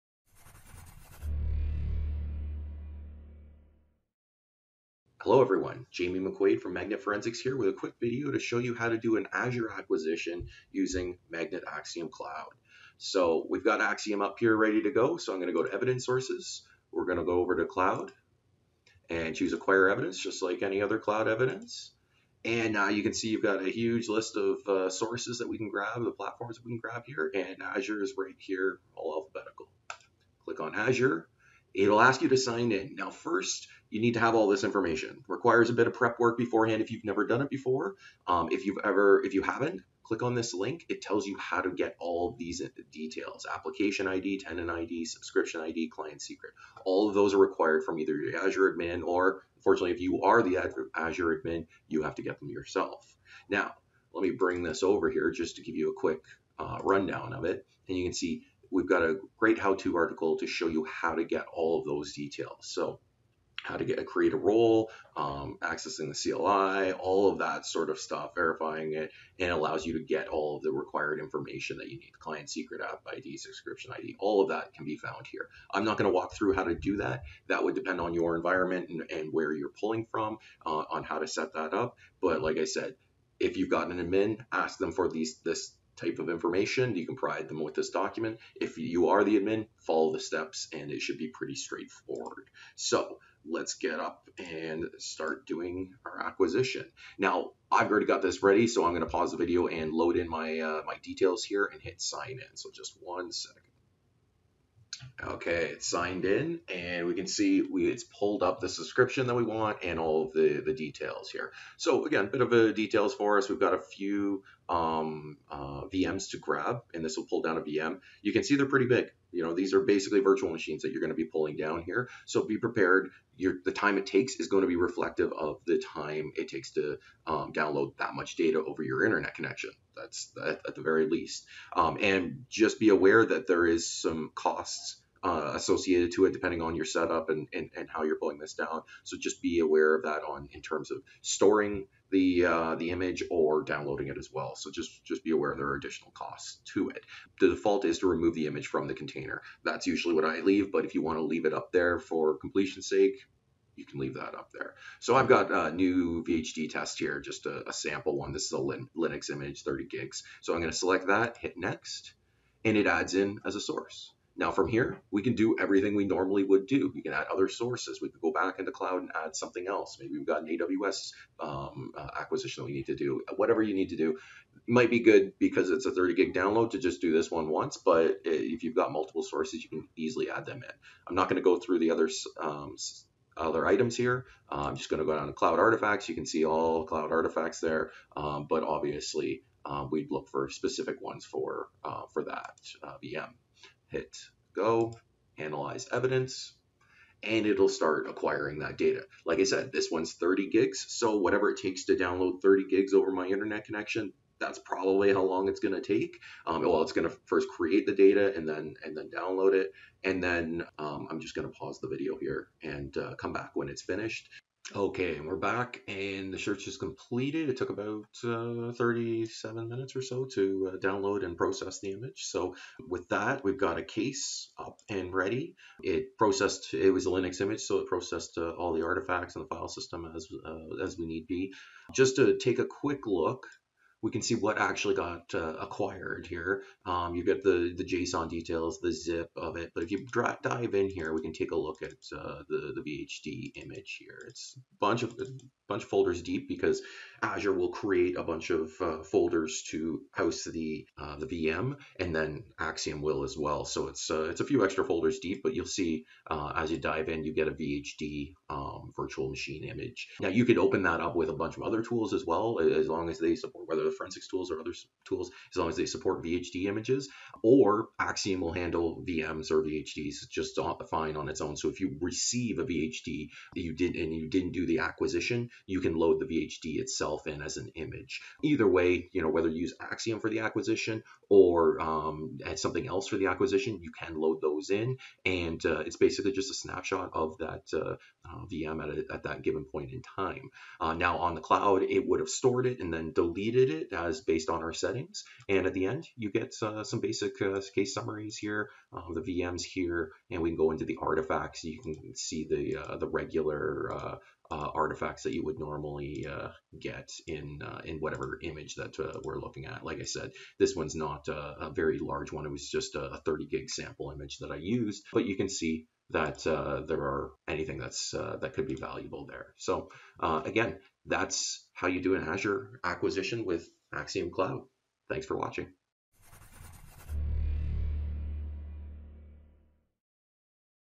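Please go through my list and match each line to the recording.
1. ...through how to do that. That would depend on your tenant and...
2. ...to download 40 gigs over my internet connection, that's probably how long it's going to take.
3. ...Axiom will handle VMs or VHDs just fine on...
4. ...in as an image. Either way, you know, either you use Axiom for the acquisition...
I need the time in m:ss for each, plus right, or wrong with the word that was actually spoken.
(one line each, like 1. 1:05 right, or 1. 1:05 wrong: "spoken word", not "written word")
1. 1:16 wrong: "environment", not "tenant"
2. 3:21 wrong: "30", not "40"
3. 4:27 right
4. 4:37 wrong: "whether", not "either".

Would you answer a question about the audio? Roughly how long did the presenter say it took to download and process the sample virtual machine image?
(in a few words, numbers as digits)
37 minutes.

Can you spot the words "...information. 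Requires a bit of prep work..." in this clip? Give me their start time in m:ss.
0:34.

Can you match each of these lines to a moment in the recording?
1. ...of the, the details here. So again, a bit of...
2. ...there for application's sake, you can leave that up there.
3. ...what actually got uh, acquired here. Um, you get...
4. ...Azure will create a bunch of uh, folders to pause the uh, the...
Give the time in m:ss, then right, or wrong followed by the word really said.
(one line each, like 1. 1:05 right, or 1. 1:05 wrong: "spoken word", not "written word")
1. 1:50 right
2. 2:31 wrong: "completion", not "application"
3. 3:54 right
4. 4:07 wrong: "house", not "pause".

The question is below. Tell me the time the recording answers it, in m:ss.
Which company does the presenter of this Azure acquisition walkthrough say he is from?
0:06.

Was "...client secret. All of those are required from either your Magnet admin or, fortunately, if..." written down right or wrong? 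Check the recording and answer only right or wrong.
wrong.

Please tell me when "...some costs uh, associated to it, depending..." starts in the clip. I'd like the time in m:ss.
2:13.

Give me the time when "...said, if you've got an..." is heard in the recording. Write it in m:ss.
1:22.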